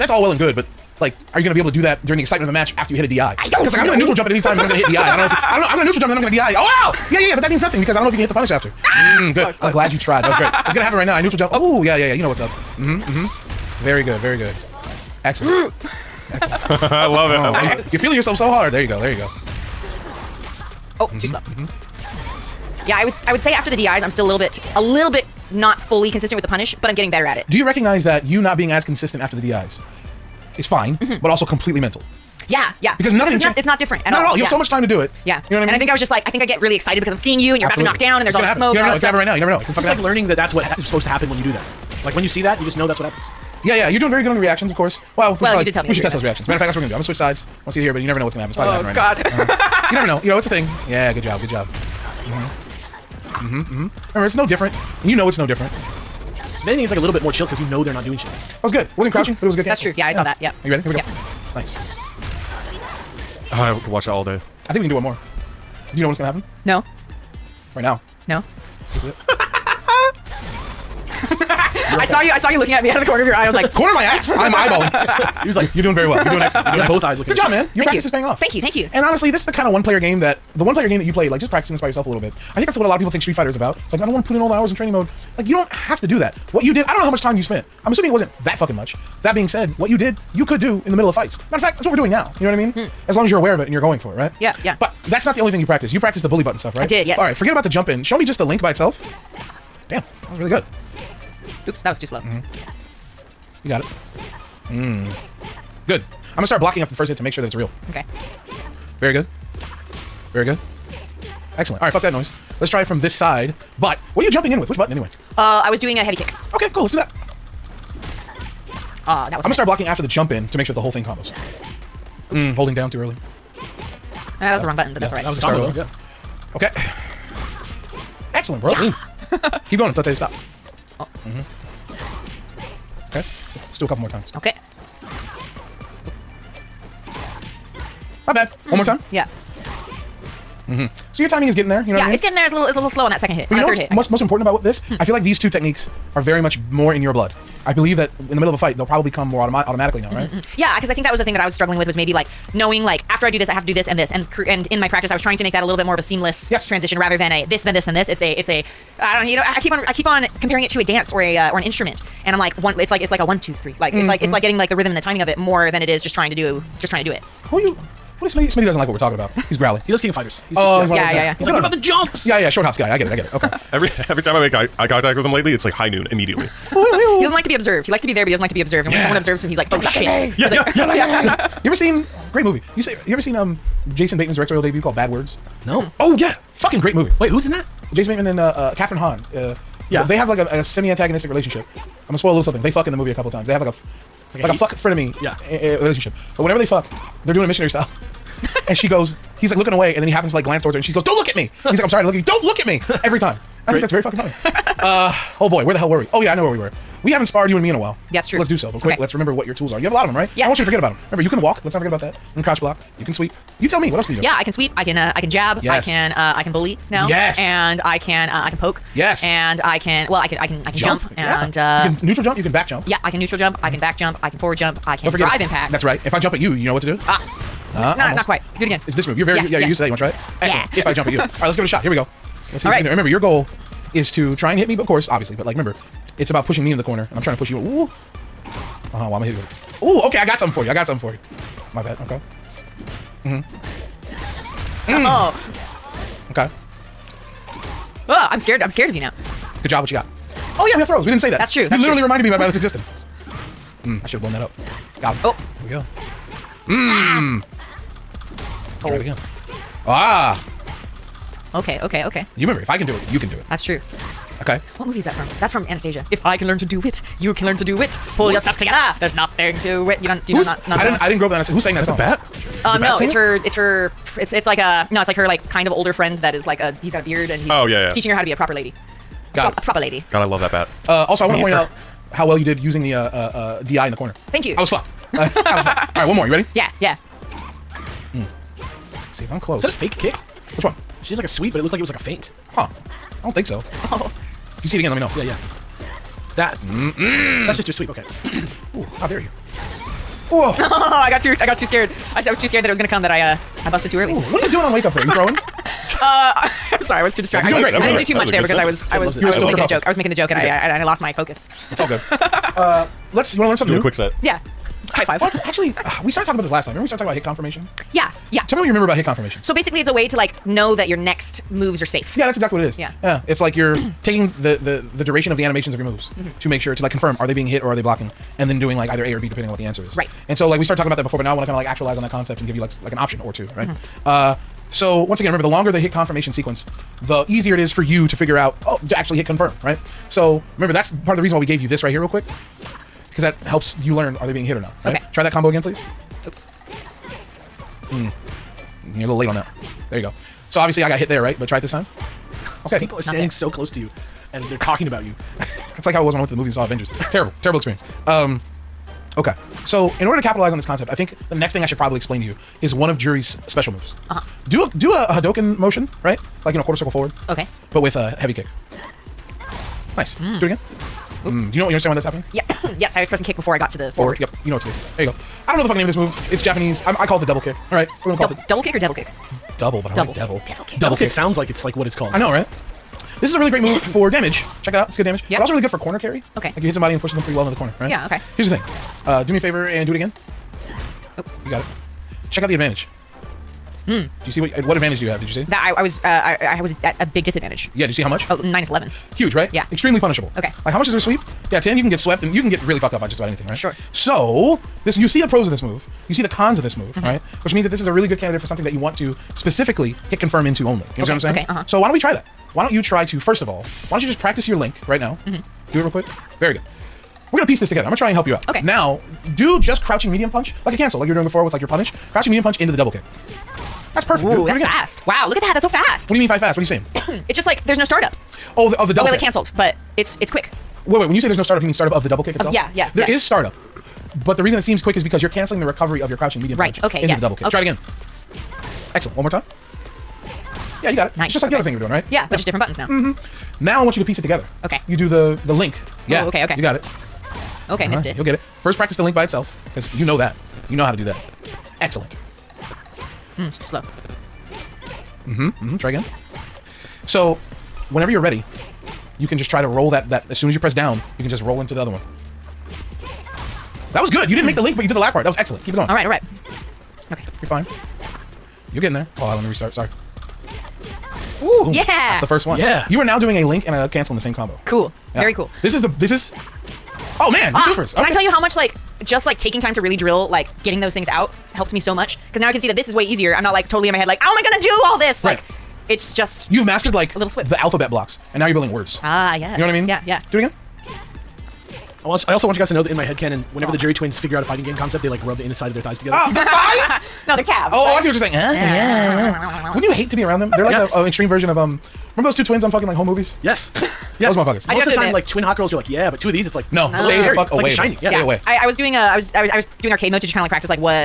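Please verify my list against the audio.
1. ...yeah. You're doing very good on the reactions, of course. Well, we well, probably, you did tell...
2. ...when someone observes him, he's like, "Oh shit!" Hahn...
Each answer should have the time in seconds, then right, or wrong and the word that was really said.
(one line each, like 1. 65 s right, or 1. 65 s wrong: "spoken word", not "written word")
1. 43 s right
2. 178 s wrong: "Yeah", not "Hahn".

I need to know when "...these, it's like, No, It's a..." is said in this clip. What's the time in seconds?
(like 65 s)
506 s.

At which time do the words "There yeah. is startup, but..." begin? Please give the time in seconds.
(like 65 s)
432 s.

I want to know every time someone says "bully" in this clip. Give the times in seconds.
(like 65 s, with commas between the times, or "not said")
96 s, 216 s.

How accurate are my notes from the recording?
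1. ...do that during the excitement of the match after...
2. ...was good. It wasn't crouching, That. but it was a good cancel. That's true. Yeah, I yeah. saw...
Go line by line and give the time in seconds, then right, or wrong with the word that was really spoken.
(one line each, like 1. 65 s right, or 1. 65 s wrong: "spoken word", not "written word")
1. 1 s right
2. 58 s wrong: "Ooh", not "That".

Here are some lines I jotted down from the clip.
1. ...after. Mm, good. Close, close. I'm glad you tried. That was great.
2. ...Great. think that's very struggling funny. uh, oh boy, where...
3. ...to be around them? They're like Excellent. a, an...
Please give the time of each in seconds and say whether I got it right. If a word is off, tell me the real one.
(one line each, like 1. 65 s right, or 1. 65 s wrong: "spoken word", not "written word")
1. 8 s right
2. 203 s wrong: "fucking", not "struggling"
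3. 500 s wrong: "Yeah", not "Excellent".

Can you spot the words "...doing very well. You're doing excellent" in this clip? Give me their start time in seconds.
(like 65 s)
75 s.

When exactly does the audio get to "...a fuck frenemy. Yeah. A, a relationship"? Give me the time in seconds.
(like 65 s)
194 s.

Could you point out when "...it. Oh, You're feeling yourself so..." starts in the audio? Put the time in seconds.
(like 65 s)
17 s.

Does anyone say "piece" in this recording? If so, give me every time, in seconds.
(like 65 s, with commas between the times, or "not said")
417 s, 444 s.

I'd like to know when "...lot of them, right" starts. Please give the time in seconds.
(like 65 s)
209 s.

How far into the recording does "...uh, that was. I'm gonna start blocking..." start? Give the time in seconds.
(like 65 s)
119 s.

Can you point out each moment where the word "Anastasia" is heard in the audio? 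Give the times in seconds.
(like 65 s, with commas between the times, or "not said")
265 s, 271 s.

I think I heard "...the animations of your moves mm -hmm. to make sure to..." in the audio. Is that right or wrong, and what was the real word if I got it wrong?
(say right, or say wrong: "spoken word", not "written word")
right.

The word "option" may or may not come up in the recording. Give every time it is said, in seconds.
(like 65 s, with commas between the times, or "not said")
333 s.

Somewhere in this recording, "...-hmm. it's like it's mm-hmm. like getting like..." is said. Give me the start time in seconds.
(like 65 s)
163 s.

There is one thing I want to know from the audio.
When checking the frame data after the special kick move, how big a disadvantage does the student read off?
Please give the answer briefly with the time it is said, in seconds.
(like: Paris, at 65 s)
minus 11, at 398 s.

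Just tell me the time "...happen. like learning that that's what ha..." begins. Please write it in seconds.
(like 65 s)
39 s.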